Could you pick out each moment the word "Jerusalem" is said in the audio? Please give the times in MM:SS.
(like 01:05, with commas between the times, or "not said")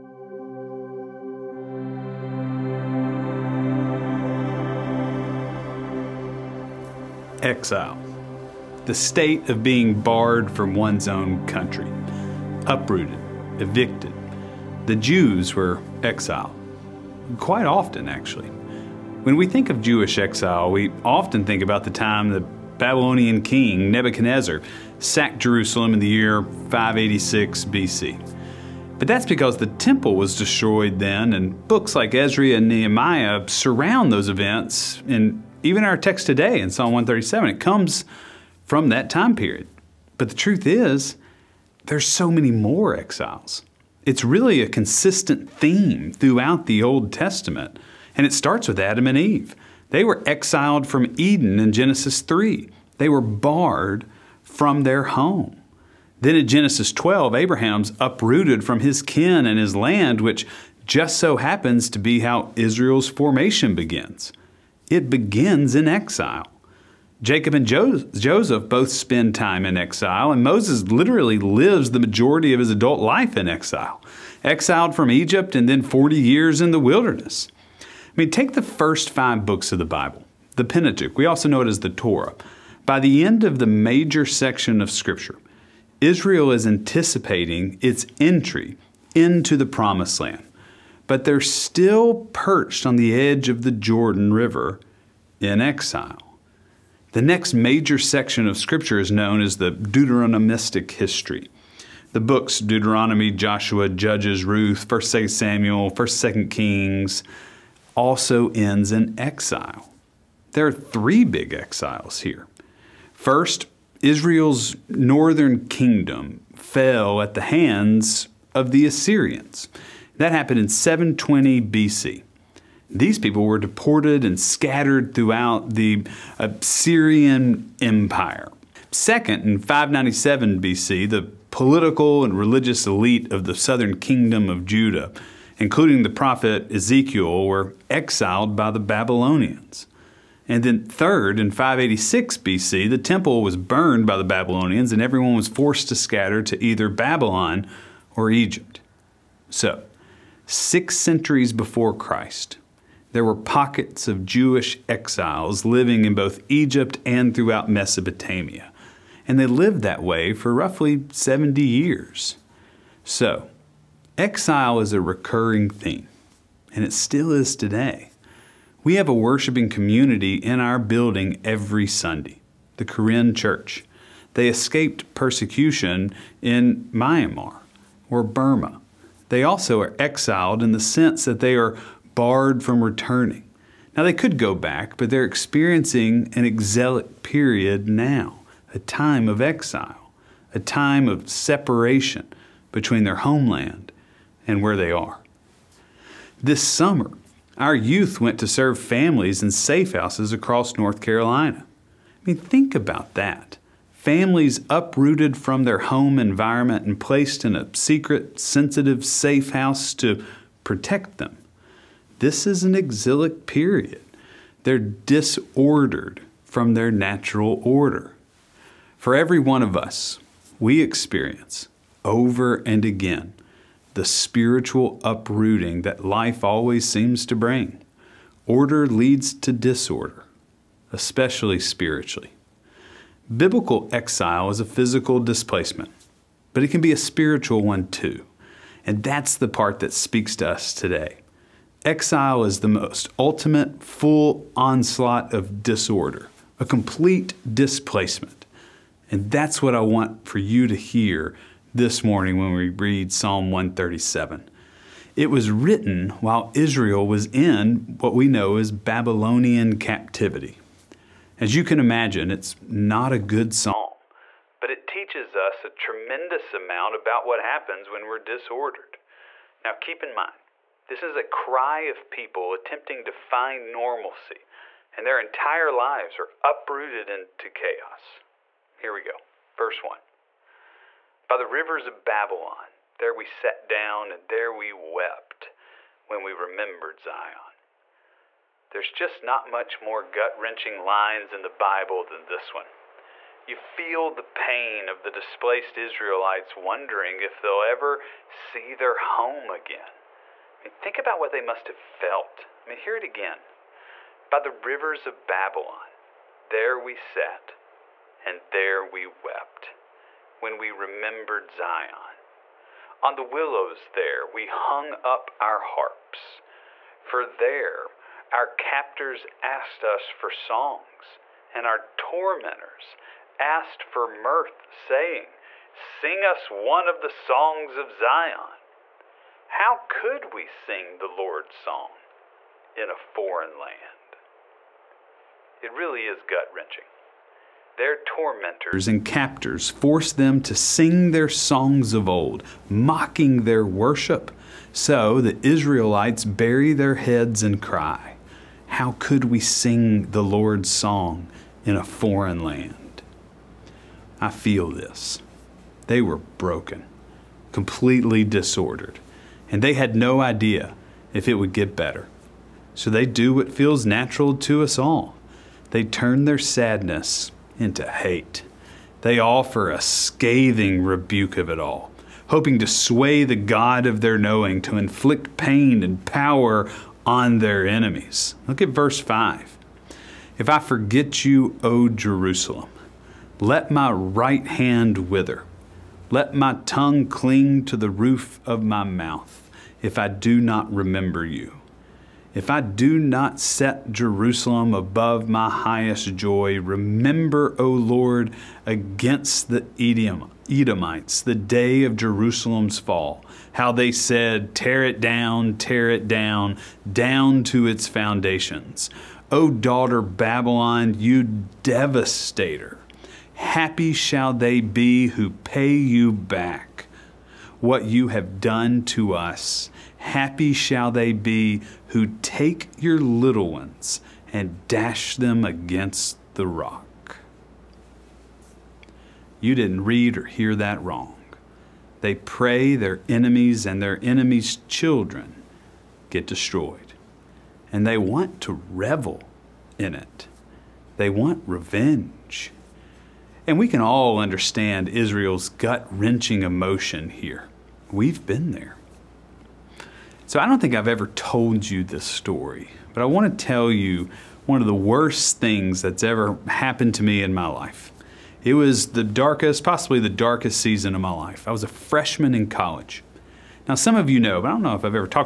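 00:25, 06:21, 06:33, 06:41.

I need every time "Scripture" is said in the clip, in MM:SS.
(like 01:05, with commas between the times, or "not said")
01:24, 01:38.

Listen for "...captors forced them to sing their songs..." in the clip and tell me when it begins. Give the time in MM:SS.
05:39.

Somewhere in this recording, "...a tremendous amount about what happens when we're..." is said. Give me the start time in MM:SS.
04:25.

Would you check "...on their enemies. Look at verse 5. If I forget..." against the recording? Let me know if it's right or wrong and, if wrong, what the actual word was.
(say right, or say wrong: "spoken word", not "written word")
right.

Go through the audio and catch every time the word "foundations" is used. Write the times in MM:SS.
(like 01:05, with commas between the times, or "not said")
06:47.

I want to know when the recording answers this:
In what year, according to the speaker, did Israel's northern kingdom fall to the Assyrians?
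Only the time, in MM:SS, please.
02:00.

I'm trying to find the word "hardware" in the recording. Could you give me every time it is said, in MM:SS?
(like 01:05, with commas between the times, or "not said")
not said.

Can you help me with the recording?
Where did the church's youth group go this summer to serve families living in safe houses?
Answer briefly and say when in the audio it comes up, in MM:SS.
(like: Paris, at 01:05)
North Carolina, at 03:20.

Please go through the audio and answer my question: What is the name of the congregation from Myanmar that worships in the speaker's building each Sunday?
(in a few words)
the Karen Church.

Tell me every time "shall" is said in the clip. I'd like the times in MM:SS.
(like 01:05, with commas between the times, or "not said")
06:53, 07:00.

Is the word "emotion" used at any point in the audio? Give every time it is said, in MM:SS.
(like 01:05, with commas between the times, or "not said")
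07:26.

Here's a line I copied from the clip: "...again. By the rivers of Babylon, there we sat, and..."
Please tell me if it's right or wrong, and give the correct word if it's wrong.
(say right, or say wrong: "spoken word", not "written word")
right.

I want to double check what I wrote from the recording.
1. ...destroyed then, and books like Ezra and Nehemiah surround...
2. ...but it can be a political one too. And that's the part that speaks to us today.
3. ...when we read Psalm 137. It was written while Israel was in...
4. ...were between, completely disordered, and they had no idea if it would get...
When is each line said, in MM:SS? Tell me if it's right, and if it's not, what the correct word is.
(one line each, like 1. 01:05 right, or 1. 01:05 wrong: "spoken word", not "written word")
1. 00:30 right
2. 03:56 wrong: "spiritual", not "political"
3. 04:12 right
4. 05:56 wrong: "broken", not "between".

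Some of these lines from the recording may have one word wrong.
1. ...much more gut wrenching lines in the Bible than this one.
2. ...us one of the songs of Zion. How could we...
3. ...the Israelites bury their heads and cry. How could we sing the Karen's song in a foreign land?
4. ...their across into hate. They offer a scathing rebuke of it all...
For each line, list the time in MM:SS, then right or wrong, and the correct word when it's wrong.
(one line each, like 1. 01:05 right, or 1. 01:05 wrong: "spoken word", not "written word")
1. 04:49 right
2. 05:26 right
3. 05:45 wrong: "Lord", not "Karen"
4. 06:06 wrong: "sadness", not "across".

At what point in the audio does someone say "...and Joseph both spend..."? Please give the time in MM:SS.
01:07.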